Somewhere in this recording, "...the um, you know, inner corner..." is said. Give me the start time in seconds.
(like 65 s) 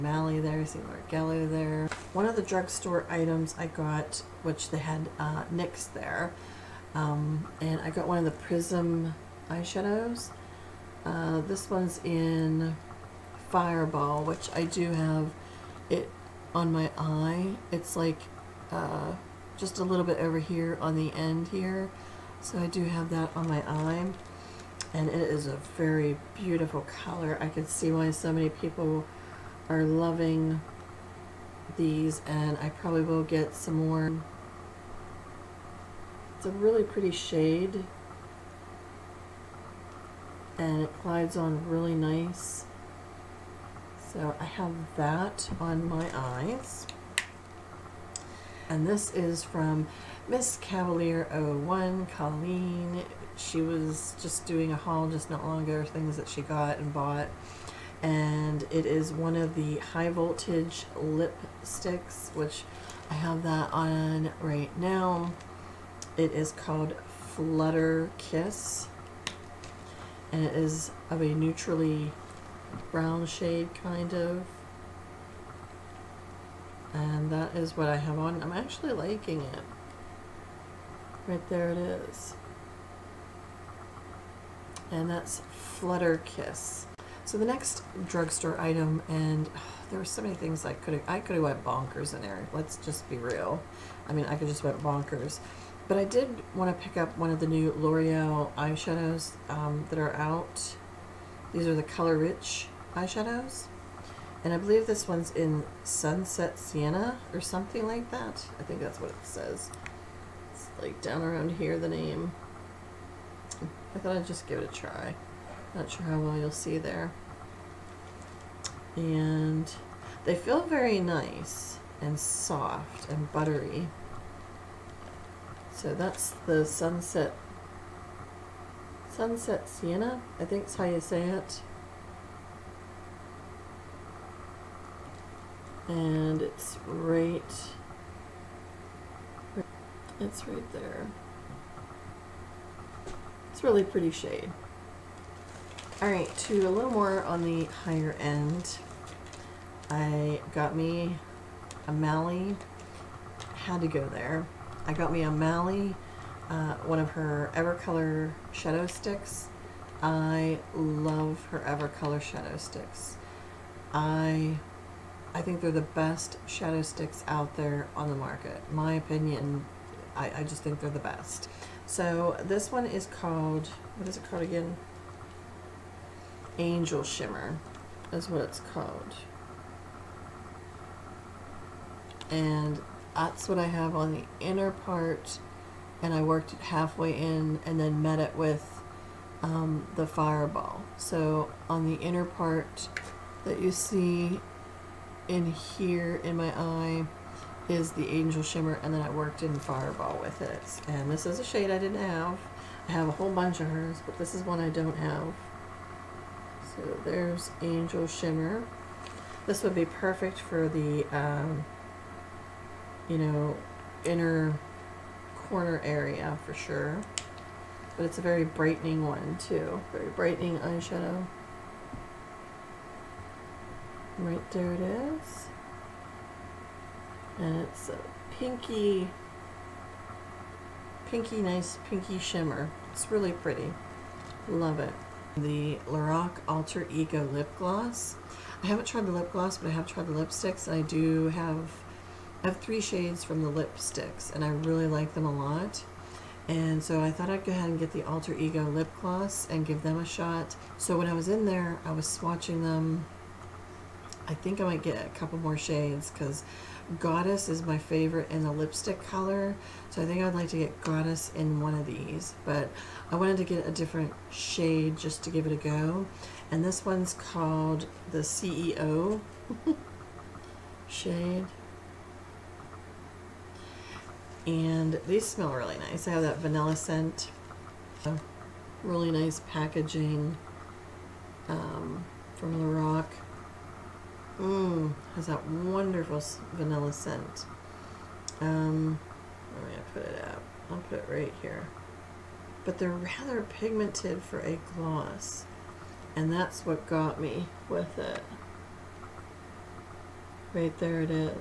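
210 s.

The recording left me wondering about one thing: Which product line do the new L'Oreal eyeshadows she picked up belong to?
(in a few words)
Color Rich.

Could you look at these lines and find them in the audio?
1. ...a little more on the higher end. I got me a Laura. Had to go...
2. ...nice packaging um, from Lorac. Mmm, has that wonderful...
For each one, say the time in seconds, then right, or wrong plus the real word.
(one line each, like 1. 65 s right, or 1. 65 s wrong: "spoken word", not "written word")
1. 146 s wrong: "Mally", not "Laura"
2. 279 s right.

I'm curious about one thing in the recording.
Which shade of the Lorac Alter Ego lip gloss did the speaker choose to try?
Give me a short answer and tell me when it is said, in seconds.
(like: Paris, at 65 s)
CEO, at 268 s.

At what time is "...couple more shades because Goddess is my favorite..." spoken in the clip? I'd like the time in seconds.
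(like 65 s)
255 s.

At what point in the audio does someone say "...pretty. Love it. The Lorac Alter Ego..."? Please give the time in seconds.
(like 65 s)
233 s.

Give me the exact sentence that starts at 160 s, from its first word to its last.
I love her Evercolor shadow sticks.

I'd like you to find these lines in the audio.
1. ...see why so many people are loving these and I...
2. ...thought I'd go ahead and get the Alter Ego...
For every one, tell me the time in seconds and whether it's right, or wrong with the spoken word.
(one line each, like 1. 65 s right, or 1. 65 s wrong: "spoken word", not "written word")
1. 27 s right
2. 247 s right.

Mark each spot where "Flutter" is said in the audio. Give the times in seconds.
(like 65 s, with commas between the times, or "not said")
67 s, 85 s.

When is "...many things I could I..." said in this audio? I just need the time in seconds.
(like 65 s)
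90 s.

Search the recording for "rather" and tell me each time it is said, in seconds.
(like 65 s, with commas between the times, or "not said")
292 s.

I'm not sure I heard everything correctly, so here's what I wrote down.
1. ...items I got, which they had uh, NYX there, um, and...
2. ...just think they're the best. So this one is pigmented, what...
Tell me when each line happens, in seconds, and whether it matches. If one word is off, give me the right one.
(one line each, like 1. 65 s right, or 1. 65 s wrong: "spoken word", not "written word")
1. 3 s right
2. 170 s wrong: "called", not "pigmented".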